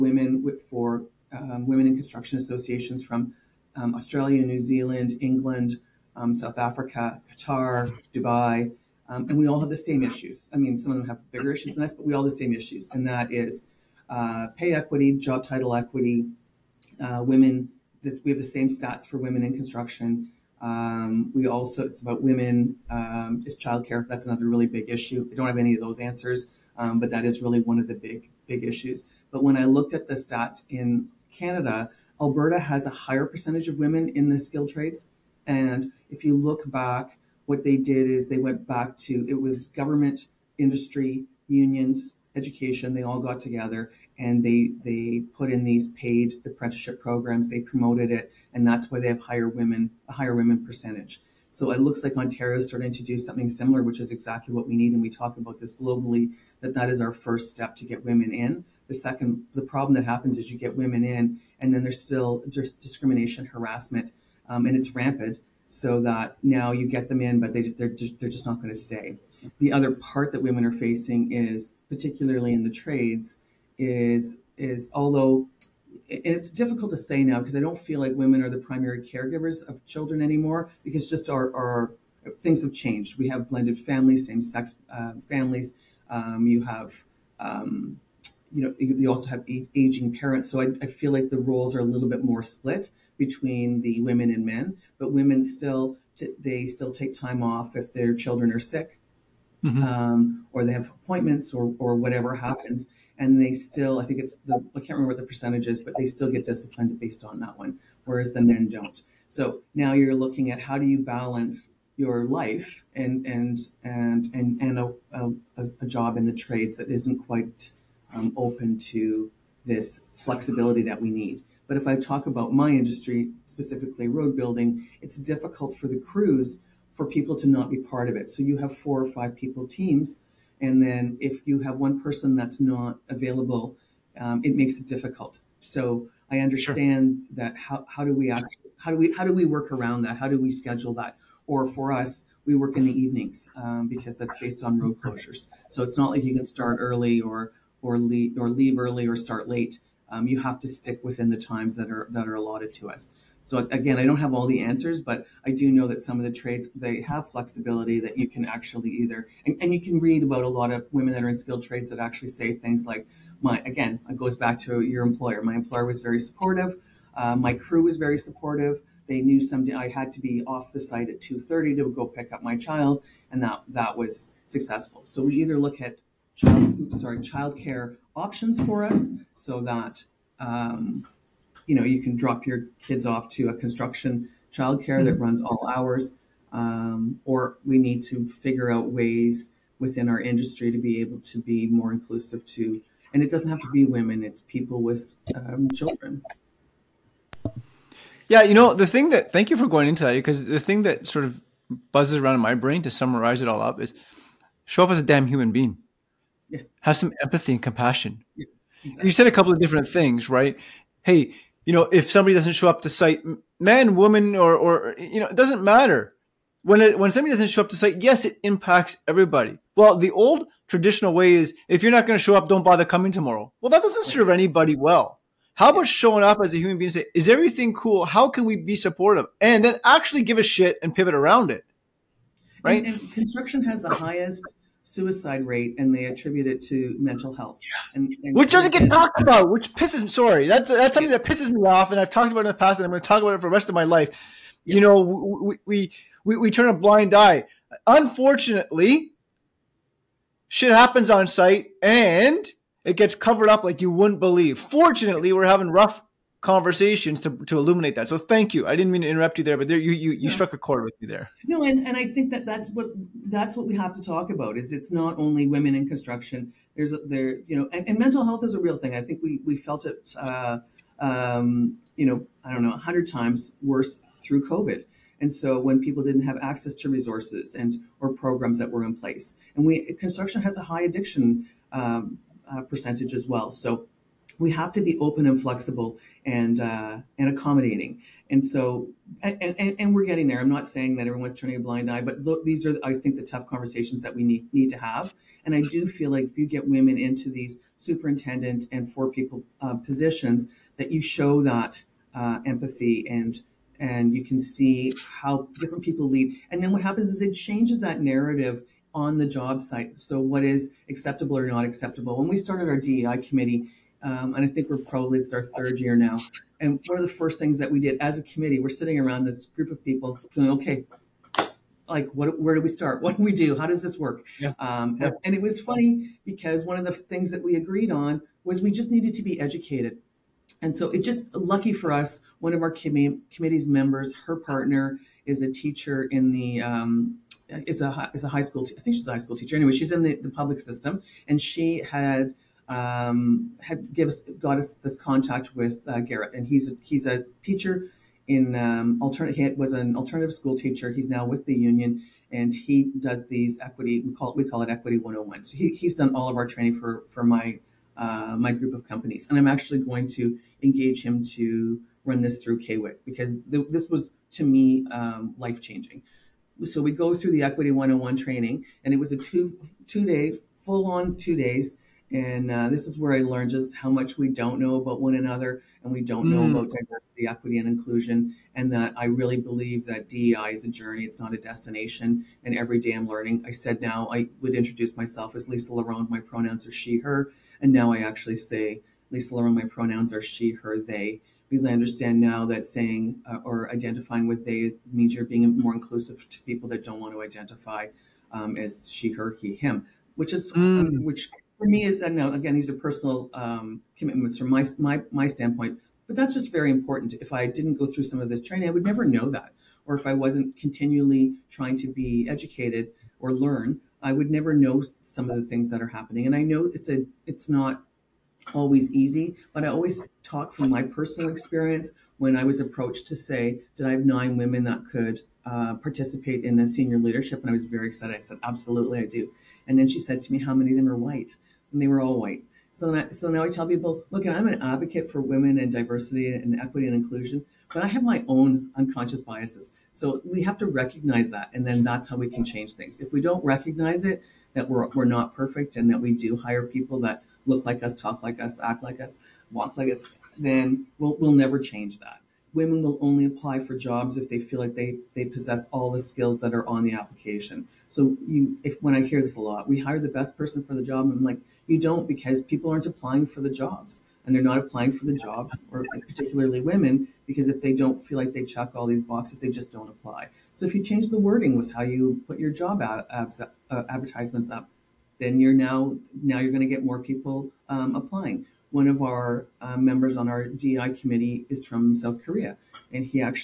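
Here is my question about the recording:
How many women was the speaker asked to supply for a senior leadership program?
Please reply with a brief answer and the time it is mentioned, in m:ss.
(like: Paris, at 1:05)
9, at 7:04.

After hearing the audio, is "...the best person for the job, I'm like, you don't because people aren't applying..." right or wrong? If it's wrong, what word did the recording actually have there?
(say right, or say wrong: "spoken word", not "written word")
right.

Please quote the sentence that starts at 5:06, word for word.
And then what happens is it changes that narrative on the job site.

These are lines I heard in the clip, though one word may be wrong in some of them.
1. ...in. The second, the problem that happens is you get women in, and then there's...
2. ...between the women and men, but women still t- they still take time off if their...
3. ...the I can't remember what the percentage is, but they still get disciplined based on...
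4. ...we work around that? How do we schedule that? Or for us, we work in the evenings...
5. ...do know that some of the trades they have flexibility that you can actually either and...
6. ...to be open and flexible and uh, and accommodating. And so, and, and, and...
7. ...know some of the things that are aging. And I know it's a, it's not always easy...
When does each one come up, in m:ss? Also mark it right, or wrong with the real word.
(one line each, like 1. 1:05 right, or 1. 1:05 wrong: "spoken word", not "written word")
1. 0:58 right
2. 1:33 right
3. 1:44 right
4. 2:19 right
5. 2:35 right
6. 4:44 right
7. 6:54 wrong: "happening", not "aging".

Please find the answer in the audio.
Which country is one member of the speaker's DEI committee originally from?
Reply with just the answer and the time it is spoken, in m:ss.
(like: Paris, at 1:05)
South Korea, at 8:01.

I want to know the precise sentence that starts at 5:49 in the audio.
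He was an alternative school teacher.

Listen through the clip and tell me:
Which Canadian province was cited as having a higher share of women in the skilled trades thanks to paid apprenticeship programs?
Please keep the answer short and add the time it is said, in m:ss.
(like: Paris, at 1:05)
Alberta, at 0:32.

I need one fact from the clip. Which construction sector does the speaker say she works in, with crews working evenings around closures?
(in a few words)
Road building.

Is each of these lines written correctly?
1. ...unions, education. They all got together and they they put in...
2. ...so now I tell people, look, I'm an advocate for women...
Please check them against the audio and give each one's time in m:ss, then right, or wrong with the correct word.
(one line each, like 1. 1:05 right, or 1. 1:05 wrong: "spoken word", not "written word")
1. 0:41 right
2. 7:13 right.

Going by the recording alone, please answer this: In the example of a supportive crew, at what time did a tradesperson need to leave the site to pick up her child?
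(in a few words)
2:30.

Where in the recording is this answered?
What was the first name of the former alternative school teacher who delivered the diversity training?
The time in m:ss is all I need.
5:46.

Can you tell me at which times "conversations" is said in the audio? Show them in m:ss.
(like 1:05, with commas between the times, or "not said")
4:16, 4:53.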